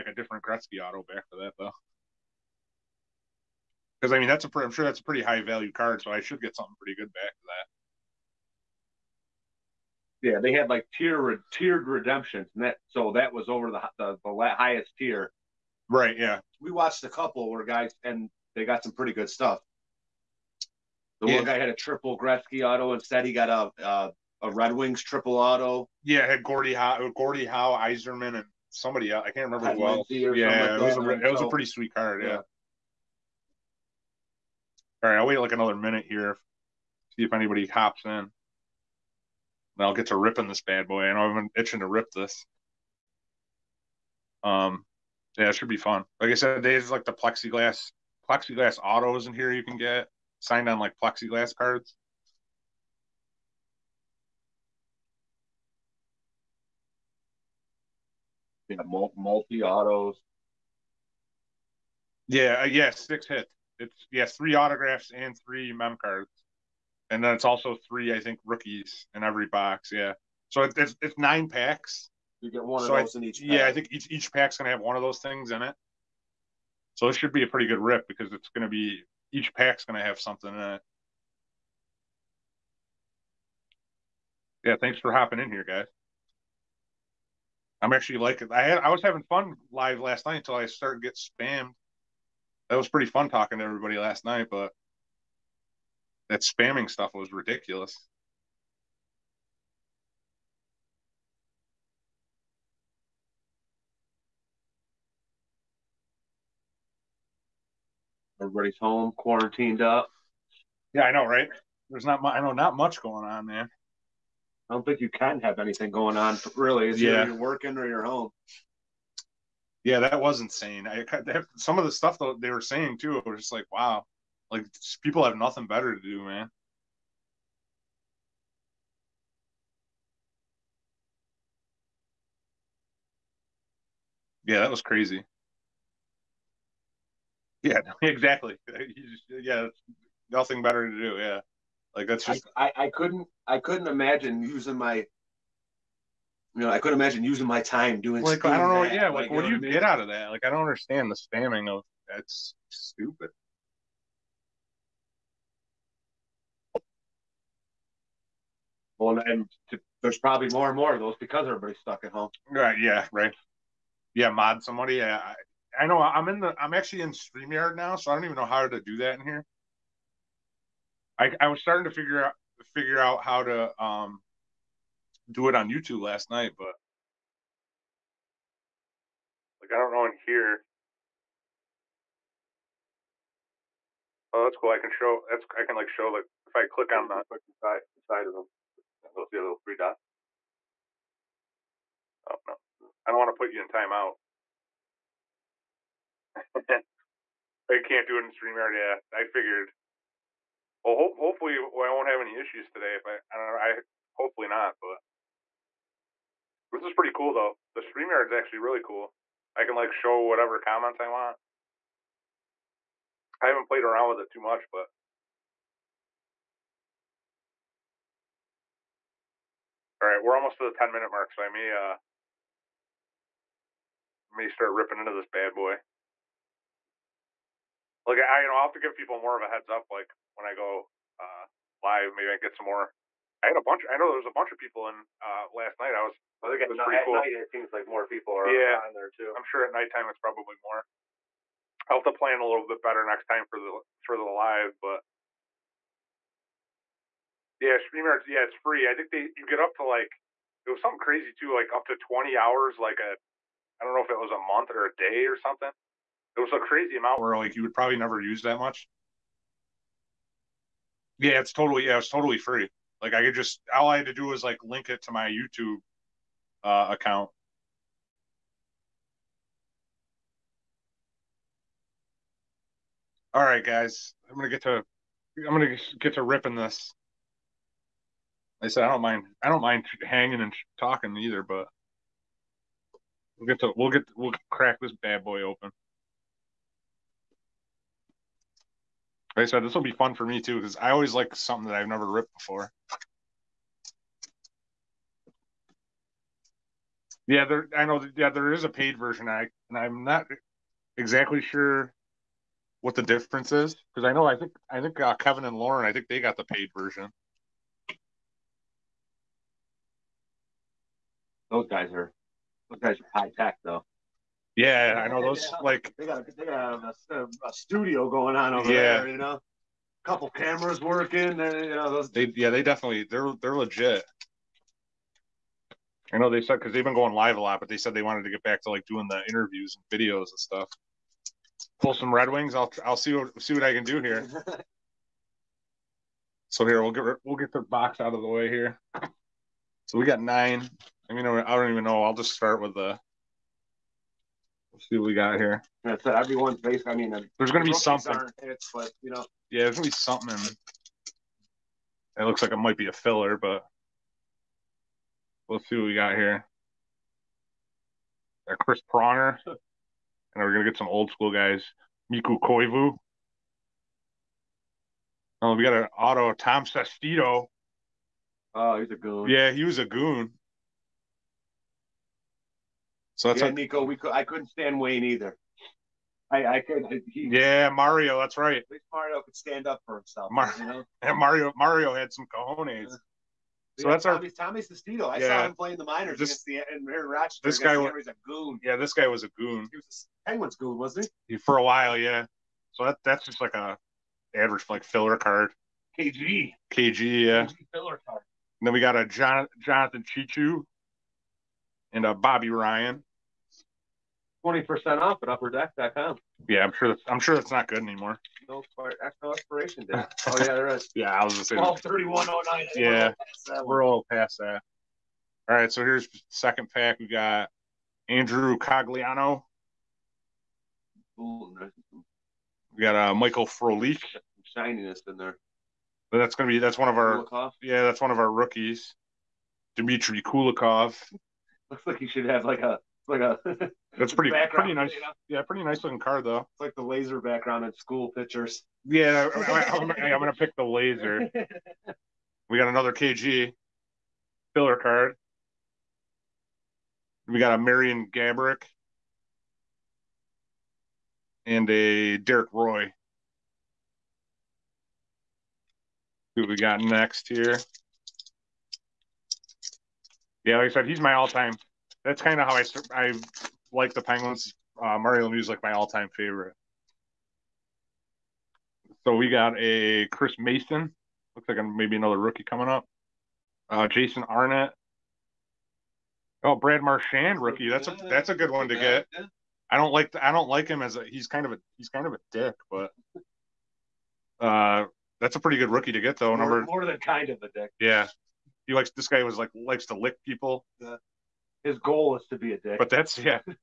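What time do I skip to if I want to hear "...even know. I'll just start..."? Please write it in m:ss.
5:41.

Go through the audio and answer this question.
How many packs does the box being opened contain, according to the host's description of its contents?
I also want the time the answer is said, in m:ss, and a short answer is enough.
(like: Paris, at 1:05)
9, at 1:11.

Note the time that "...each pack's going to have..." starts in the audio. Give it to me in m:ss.
1:19.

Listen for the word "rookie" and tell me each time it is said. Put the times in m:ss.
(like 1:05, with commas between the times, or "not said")
1:08, 7:08, 7:52, 7:57, 8:05.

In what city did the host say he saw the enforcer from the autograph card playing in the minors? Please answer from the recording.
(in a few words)
Rochester.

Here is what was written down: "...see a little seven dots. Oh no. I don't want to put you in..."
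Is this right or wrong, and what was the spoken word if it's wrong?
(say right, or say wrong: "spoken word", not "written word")
wrong: "three", not "seven".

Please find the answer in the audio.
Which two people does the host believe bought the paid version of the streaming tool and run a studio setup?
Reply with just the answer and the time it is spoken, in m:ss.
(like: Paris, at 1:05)
Kevin and Lauren, at 5:05.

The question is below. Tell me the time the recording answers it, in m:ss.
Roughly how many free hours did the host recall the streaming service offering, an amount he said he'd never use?
4:11.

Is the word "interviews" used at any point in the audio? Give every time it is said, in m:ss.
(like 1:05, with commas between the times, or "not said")
5:29.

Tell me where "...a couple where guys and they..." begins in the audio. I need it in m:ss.
0:17.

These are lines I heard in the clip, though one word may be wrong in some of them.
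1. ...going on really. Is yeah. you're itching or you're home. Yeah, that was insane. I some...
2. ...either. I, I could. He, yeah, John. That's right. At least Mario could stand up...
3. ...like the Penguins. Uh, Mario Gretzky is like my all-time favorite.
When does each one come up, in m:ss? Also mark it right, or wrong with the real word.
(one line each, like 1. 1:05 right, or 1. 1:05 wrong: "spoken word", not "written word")
1. 1:55 wrong: "working", not "itching"
2. 6:15 wrong: "Mario", not "John"
3. 7:43 wrong: "Lemieux", not "Gretzky".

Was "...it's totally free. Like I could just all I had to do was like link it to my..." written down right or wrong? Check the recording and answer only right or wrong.
right.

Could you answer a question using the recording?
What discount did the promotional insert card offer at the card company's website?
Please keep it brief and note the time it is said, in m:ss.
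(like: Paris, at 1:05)
20% off, at 6:44.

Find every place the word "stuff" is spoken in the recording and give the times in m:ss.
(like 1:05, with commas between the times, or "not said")
0:19, 1:36, 2:01, 5:30.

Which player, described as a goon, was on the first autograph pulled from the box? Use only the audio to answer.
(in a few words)
Tom Sestito.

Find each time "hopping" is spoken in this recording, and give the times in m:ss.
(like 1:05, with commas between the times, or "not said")
1:25.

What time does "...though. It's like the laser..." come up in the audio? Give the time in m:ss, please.
7:16.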